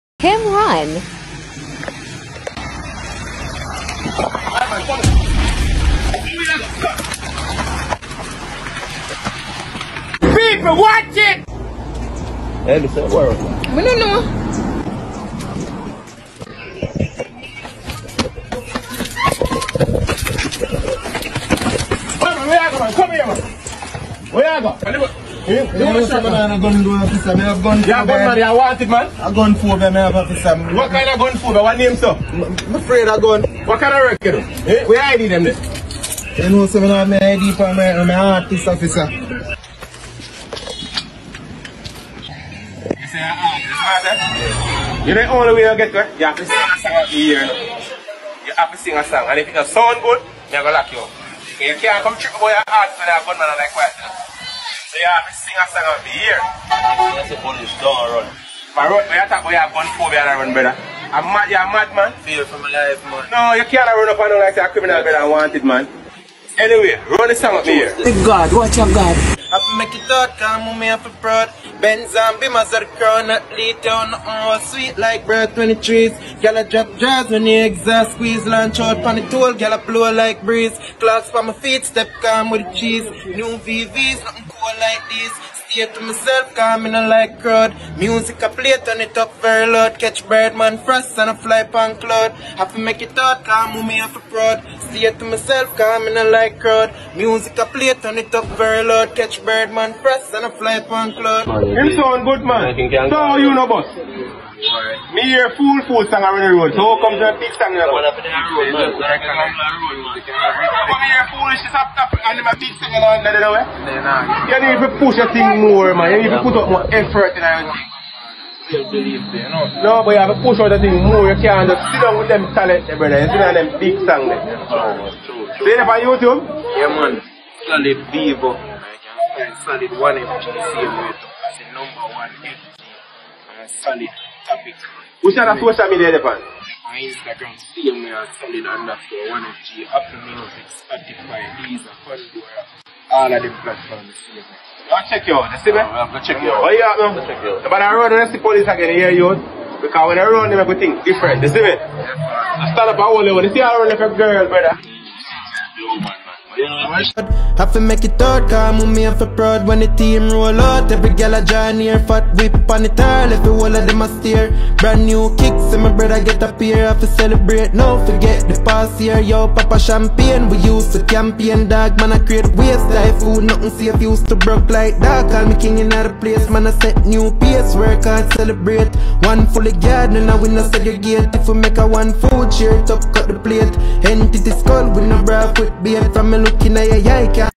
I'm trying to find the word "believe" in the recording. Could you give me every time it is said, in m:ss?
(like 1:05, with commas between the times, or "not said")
1:58.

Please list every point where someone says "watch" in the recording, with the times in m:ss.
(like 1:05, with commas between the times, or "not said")
0:10, 1:08.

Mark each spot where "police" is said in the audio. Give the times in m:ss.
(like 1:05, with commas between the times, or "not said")
0:57, 2:28.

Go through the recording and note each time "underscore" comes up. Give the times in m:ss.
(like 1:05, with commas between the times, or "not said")
2:18.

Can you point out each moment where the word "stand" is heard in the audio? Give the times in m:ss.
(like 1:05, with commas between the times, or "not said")
2:32.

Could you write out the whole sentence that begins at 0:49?
And if it doesn't sound good, you're going to lock you up.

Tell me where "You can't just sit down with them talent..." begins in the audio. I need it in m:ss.
2:01.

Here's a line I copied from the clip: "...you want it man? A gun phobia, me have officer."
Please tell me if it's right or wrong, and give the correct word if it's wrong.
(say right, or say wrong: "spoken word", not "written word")
right.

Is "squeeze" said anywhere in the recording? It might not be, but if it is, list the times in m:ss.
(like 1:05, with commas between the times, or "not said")
1:18.